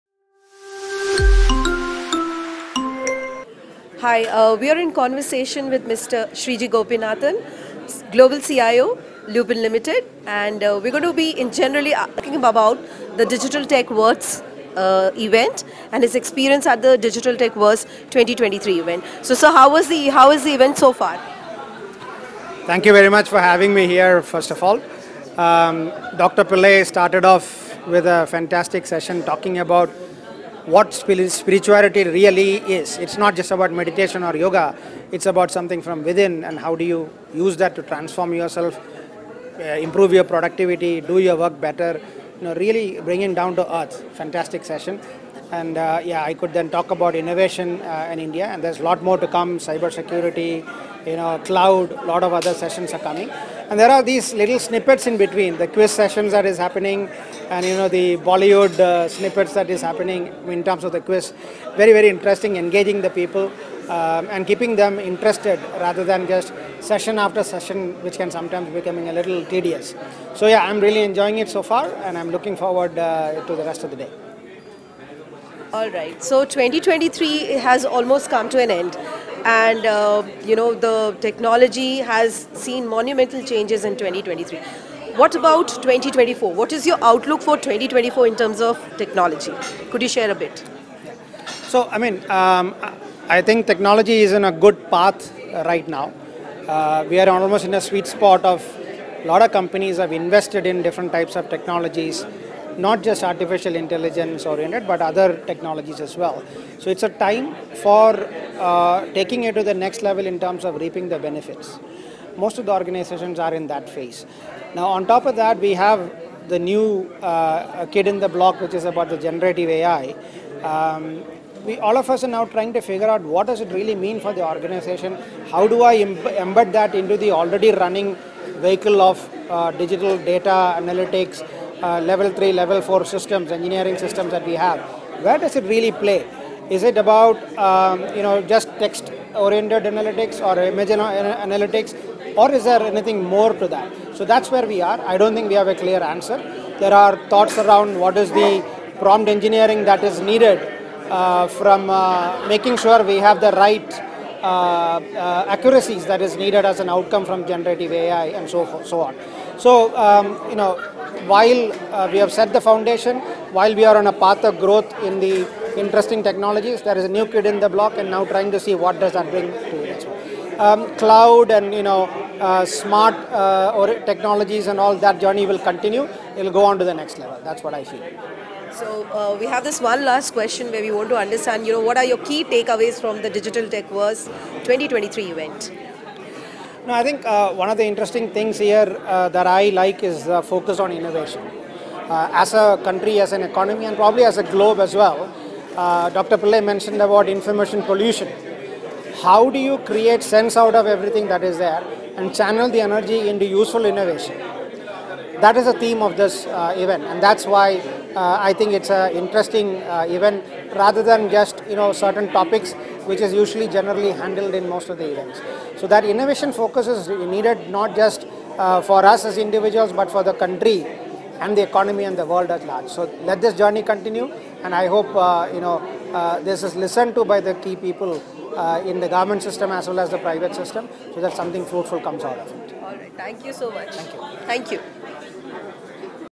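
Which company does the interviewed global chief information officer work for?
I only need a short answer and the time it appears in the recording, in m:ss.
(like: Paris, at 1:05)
Lupin Limited, at 0:09.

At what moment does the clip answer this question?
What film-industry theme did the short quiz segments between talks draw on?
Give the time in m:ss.
0:58.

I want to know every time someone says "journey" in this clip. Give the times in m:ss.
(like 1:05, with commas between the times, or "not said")
2:55, 3:43.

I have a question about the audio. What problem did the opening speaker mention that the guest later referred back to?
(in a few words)
information pollution.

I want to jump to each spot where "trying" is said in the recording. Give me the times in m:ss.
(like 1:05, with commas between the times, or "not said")
2:02, 2:48.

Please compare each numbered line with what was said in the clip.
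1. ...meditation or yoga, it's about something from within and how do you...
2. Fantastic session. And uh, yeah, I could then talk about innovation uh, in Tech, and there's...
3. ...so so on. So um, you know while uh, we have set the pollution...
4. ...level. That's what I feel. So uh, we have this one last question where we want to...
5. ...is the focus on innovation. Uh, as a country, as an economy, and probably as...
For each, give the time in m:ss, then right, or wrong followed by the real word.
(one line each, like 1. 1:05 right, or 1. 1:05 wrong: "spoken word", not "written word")
1. 0:33 right
2. 0:44 wrong: "India", not "Tech"
3. 2:38 wrong: "foundation", not "pollution"
4. 2:57 right
5. 3:10 right.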